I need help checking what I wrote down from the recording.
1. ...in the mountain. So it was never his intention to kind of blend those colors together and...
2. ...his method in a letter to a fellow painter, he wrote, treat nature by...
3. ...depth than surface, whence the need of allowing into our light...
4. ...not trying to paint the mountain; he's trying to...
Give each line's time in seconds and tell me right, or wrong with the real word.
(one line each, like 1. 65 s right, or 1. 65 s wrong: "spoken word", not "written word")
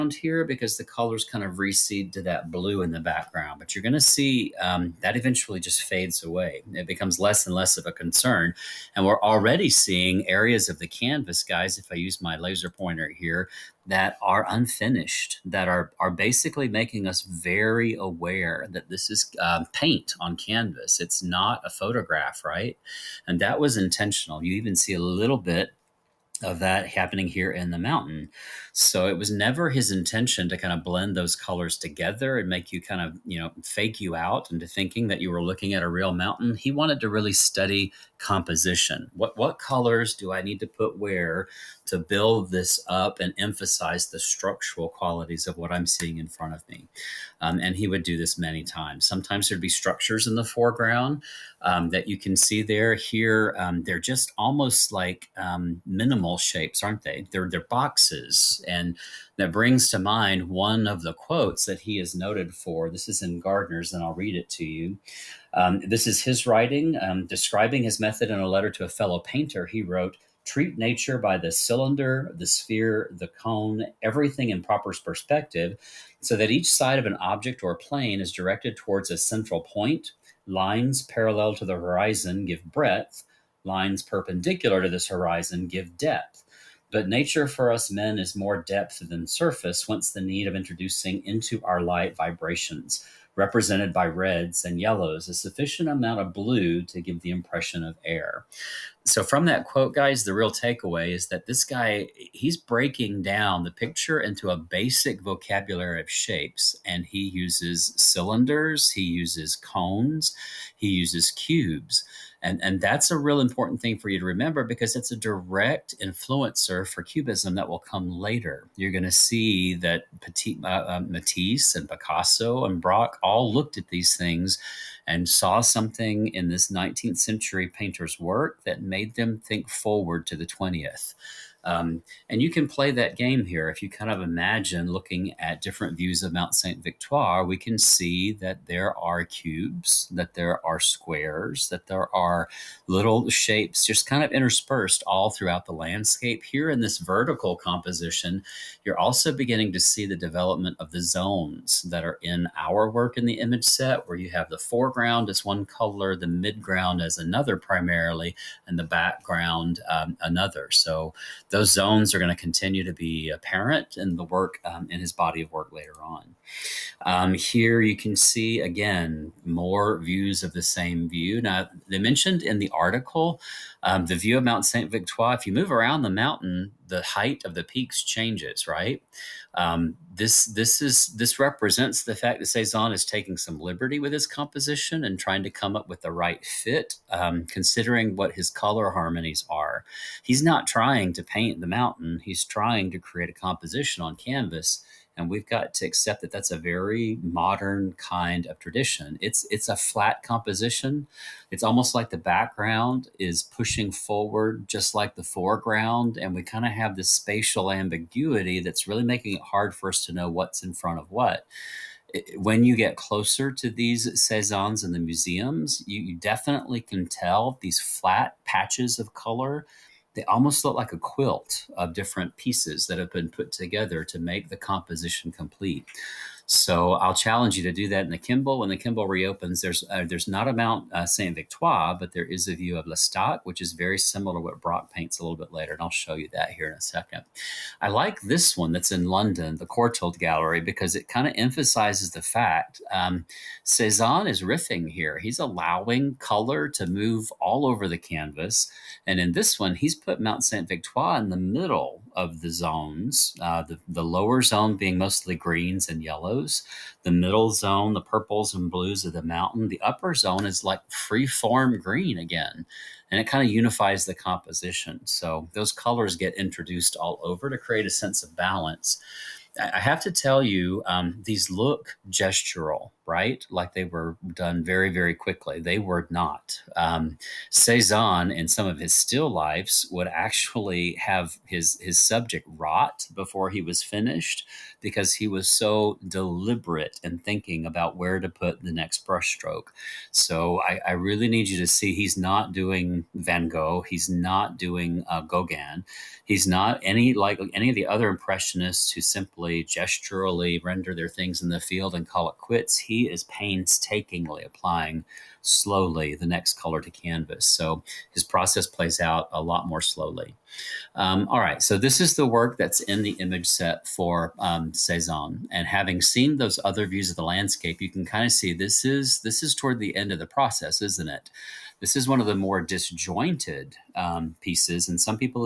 1. 27 s right
2. 67 s right
3. 88 s wrong: "introducing", not "allowing"
4. 190 s right.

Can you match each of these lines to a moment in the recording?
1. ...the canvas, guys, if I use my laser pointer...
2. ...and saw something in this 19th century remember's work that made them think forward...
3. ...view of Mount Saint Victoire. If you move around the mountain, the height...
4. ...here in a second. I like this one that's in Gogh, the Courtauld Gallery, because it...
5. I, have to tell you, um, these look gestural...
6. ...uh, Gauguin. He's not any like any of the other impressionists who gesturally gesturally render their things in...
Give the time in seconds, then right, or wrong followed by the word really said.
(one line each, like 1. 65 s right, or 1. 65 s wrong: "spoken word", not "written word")
1. 10 s right
2. 125 s wrong: "painter", not "remember"
3. 174 s right
4. 236 s wrong: "London", not "Gogh"
5. 269 s right
6. 295 s wrong: "simply", not "gesturally".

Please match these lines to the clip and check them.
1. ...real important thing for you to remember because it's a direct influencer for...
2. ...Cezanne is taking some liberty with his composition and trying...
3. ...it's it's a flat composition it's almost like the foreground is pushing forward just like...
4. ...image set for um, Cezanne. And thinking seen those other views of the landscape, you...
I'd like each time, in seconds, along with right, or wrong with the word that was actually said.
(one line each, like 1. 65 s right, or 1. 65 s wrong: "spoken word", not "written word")
1. 113 s right
2. 182 s right
3. 199 s wrong: "background", not "foreground"
4. 313 s wrong: "having", not "thinking".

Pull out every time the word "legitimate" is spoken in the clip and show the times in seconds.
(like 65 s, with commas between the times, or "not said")
not said.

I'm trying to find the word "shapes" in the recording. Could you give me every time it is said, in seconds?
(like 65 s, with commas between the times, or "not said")
56 s, 106 s, 143 s.